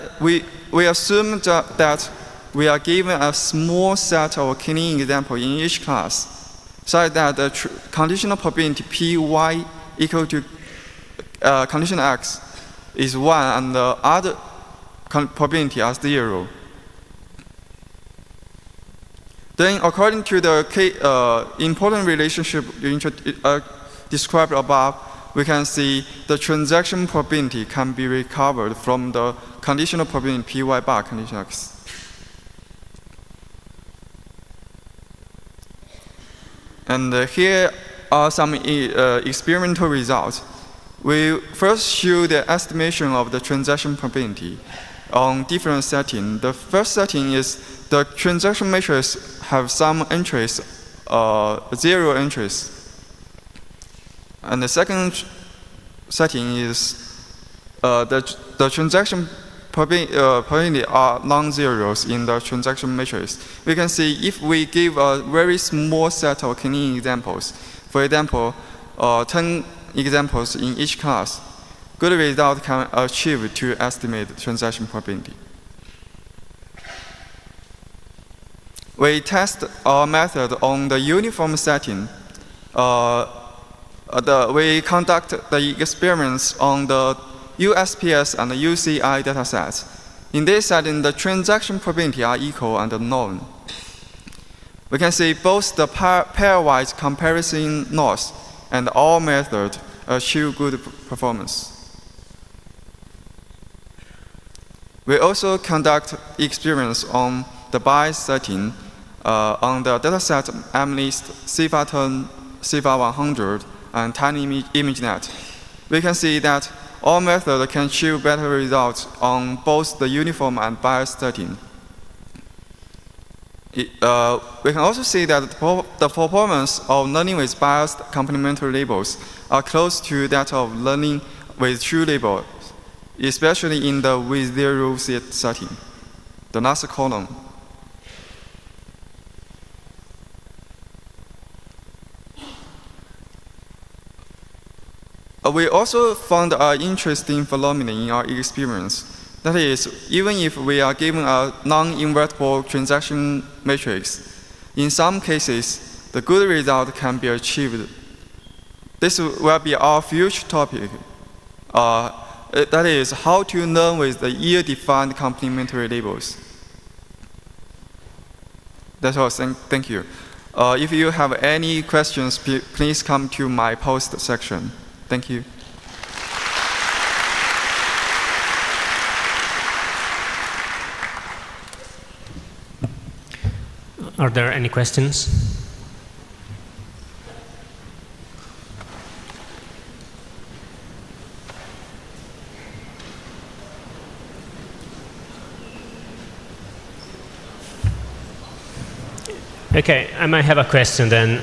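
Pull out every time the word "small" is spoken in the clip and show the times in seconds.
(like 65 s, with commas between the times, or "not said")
3 s, 65 s.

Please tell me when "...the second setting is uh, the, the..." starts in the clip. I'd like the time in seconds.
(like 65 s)
54 s.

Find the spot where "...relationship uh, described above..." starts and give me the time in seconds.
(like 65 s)
22 s.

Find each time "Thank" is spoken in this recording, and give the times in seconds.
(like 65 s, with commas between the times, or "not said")
169 s, 175 s.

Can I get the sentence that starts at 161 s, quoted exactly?
Uh, that is, how to learn with the year-defined complementary labels.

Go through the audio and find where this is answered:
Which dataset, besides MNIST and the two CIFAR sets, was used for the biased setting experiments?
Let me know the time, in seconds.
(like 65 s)
114 s.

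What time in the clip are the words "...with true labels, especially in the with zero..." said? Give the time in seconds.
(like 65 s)
131 s.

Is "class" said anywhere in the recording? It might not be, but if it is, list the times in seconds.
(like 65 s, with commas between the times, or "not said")
5 s, 70 s.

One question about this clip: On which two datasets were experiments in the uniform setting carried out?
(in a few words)
USPS and UCI.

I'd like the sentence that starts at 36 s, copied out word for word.
And uh, here are some e uh, experimental results.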